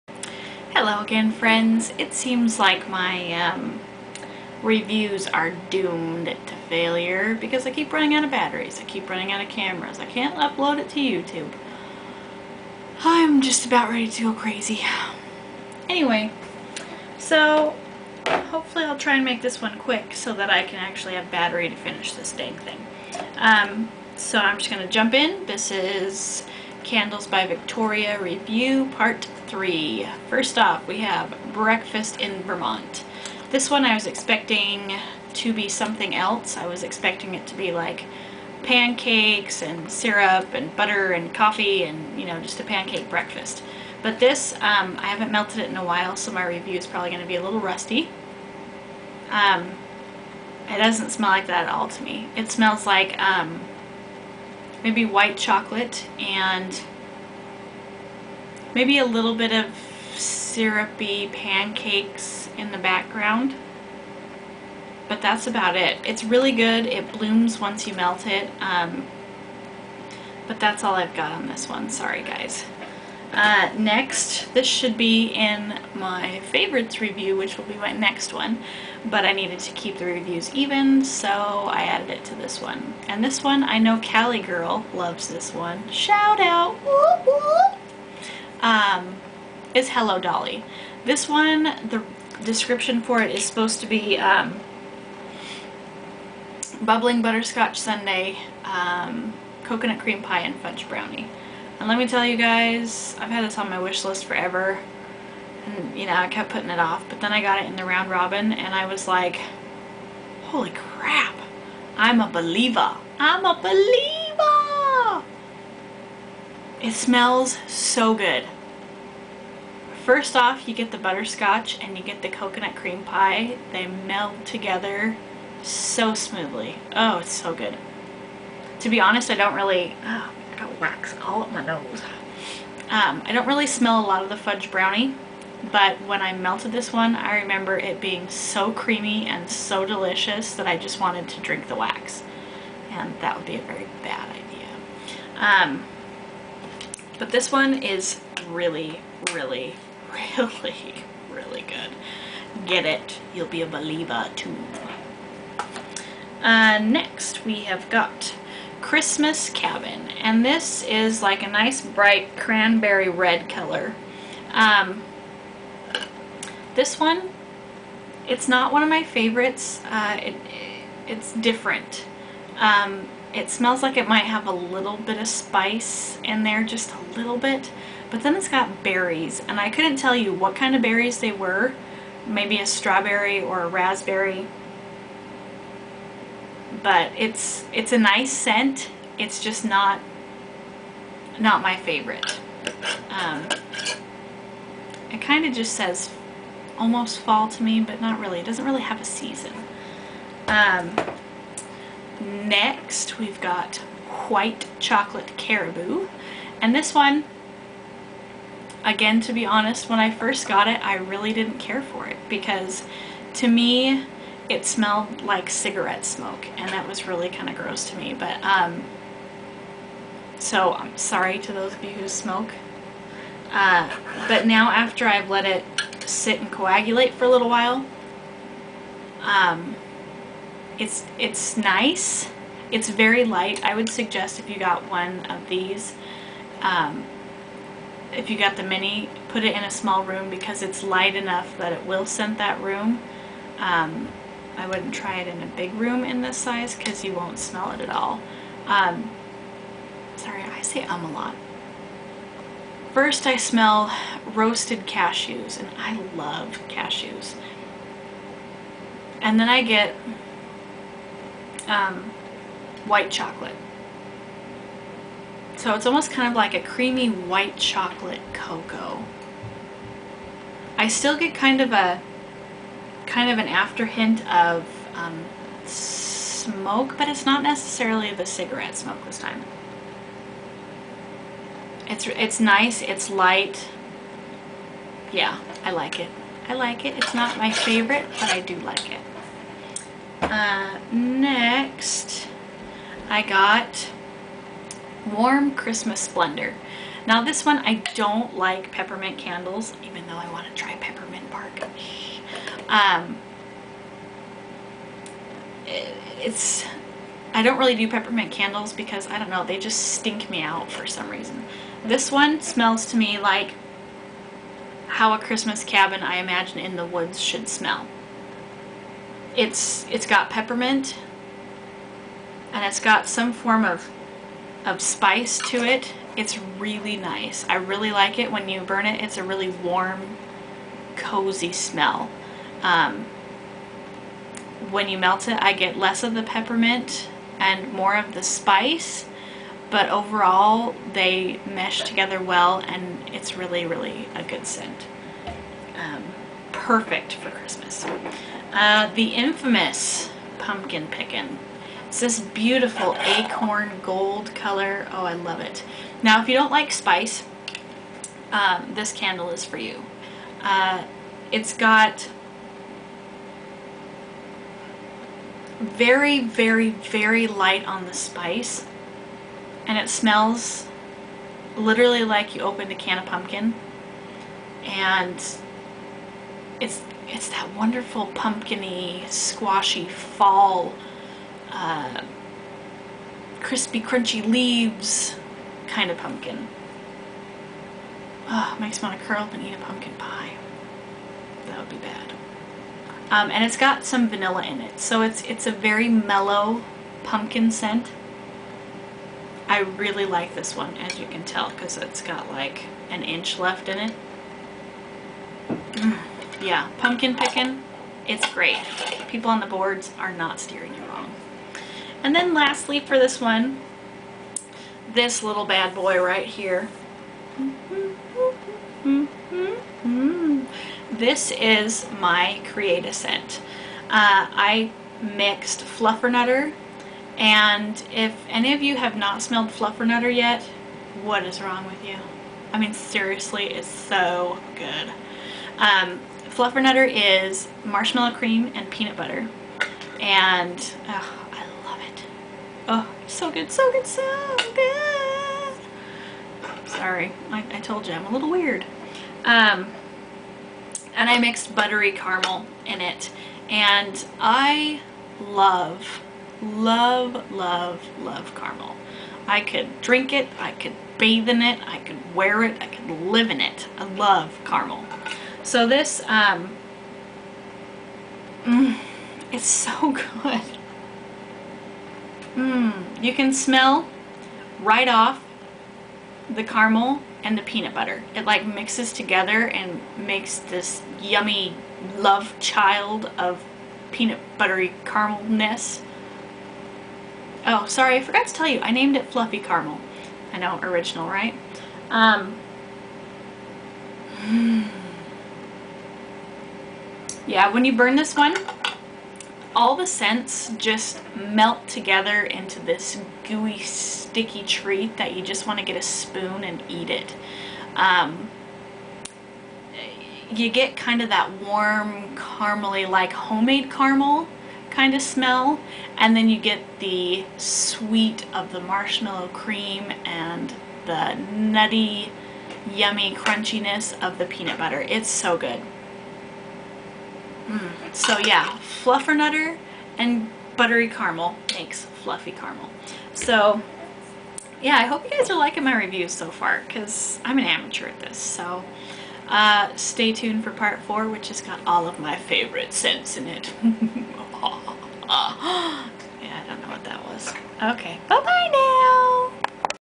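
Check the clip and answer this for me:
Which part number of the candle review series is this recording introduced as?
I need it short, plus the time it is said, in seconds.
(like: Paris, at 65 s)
Part 3, at 28 s.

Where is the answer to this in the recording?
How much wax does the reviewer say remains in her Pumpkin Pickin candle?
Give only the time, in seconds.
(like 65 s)
402 s.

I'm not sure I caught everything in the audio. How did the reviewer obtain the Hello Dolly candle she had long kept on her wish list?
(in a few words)
Round robin.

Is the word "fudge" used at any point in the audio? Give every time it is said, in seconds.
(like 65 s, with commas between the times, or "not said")
100 s, 134 s.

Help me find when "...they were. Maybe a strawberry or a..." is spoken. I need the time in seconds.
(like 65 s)
181 s.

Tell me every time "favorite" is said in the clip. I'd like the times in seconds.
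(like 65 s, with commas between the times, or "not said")
76 s, 169 s, 191 s, 287 s, 542 s.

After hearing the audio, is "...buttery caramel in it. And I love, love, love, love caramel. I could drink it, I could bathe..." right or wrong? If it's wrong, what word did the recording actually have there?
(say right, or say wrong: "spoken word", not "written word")
right.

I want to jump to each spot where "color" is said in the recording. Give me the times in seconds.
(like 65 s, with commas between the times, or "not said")
163 s, 354 s.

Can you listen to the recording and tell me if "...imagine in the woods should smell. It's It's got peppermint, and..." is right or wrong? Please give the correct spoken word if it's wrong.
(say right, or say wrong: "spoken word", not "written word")
right.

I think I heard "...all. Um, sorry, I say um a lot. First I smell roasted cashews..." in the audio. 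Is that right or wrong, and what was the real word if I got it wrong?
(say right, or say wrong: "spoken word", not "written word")
right.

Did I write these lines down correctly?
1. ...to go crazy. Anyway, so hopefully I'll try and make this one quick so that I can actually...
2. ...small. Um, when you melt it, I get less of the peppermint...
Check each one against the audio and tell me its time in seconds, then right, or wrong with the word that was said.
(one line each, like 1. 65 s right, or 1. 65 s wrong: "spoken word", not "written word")
1. 14 s right
2. 331 s wrong: "smell", not "small".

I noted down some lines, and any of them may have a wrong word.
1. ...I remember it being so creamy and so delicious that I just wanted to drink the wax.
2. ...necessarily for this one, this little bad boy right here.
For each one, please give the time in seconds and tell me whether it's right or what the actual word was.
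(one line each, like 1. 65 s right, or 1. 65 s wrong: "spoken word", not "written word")
1. 137 s right
2. 412 s wrong: "lastly", not "necessarily".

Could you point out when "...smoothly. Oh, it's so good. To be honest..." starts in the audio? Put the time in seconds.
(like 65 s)
126 s.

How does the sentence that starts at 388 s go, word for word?
Oh, makes me want to curl up and eat a pumpkin pie.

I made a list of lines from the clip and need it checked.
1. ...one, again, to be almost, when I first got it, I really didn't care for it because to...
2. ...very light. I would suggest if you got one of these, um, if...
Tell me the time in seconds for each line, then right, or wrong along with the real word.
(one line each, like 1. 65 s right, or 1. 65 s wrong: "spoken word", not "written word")
1. 206 s wrong: "honest", not "almost"
2. 232 s right.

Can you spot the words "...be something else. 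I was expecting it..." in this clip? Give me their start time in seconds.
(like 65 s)
35 s.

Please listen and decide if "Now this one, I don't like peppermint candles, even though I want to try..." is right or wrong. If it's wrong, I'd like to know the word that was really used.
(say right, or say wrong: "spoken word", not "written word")
right.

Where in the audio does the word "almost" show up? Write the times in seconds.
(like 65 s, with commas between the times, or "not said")
196 s, 265 s.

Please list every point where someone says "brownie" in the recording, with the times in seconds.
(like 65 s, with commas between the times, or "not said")
100 s, 134 s.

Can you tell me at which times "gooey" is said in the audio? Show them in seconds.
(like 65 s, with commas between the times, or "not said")
503 s.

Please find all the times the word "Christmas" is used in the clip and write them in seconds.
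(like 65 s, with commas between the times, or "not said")
158 s, 295 s, 315 s, 347 s.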